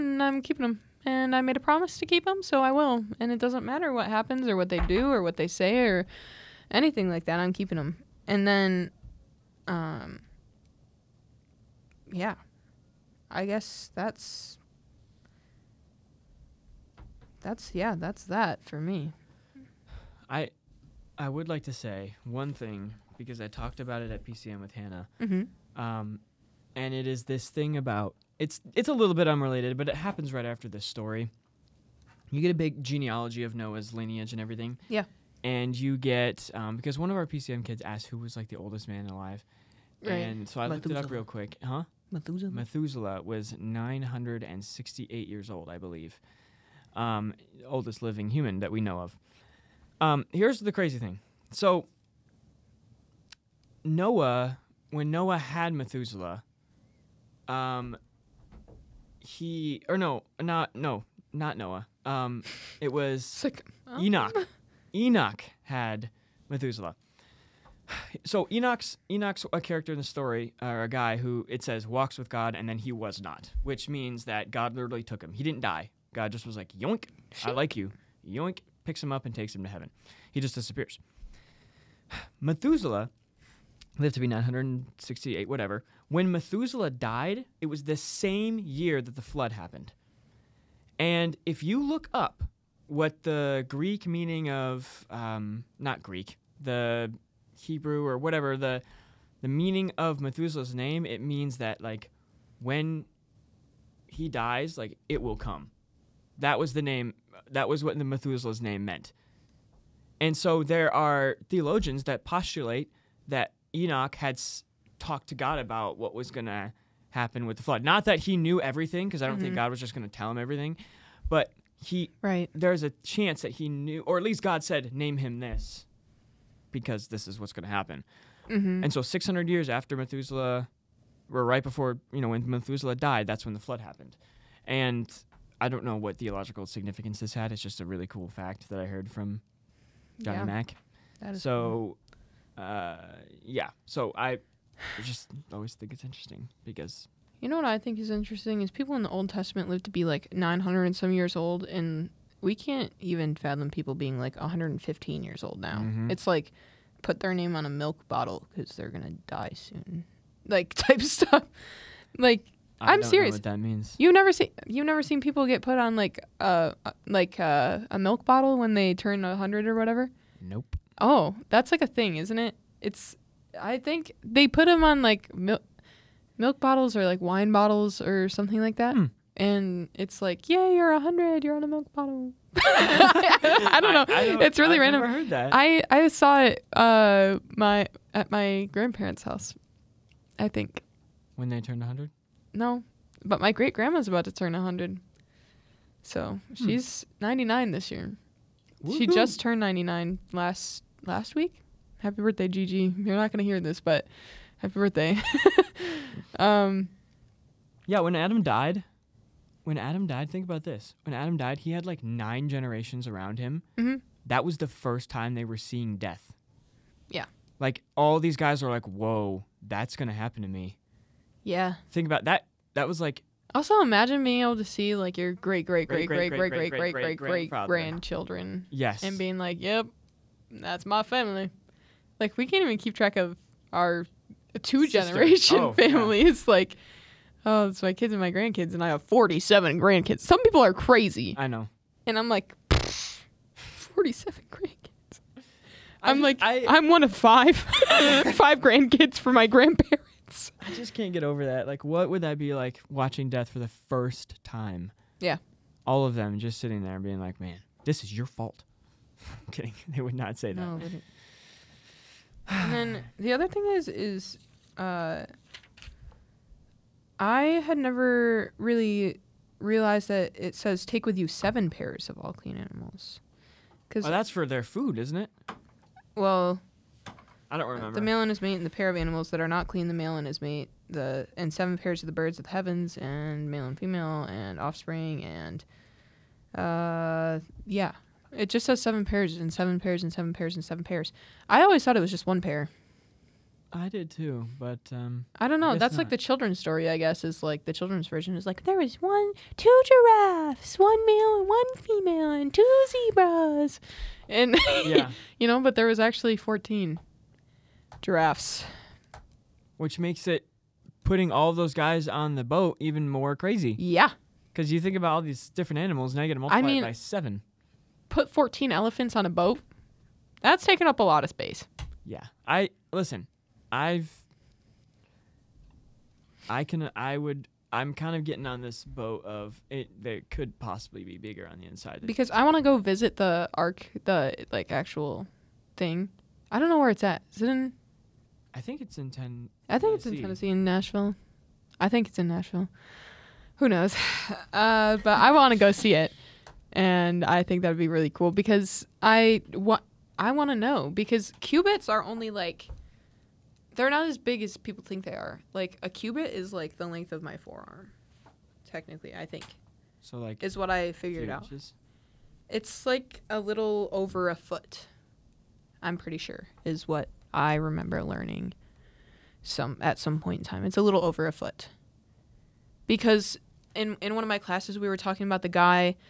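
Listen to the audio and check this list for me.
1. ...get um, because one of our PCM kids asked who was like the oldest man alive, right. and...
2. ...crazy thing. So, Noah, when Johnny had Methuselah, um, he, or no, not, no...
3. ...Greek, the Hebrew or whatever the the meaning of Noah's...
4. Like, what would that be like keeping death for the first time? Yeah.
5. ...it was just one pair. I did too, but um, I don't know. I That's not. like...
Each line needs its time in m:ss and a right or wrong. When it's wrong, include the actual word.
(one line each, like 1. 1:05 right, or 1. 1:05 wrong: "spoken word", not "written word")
1. 0:35 right
2. 0:50 wrong: "Noah", not "Johnny"
3. 1:36 wrong: "Methuselah", not "Noah"
4. 4:11 wrong: "watching", not "keeping"
5. 4:51 right.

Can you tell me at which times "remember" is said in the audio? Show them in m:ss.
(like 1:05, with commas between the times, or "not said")
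4:37, 6:07.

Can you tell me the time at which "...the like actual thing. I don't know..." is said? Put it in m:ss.
5:34.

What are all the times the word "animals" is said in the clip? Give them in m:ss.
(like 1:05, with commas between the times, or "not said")
4:32, 4:38, 5:15.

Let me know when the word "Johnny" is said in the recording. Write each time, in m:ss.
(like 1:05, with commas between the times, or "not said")
2:20.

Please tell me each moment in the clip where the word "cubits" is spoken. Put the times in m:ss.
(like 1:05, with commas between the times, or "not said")
5:51, 5:55.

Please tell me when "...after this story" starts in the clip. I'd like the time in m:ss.
0:30.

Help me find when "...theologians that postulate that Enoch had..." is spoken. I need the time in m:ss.
1:51.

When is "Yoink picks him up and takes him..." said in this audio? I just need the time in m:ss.
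1:18.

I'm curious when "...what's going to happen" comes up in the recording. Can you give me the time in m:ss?
2:07.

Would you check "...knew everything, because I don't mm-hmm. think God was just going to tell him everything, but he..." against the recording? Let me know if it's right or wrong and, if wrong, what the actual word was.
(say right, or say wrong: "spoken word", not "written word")
right.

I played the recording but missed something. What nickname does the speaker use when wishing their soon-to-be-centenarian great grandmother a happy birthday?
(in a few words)
Gigi.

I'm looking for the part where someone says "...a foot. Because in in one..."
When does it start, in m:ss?
6:11.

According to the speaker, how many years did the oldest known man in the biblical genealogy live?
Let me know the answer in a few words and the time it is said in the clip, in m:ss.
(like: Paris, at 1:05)
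968, at 0:43.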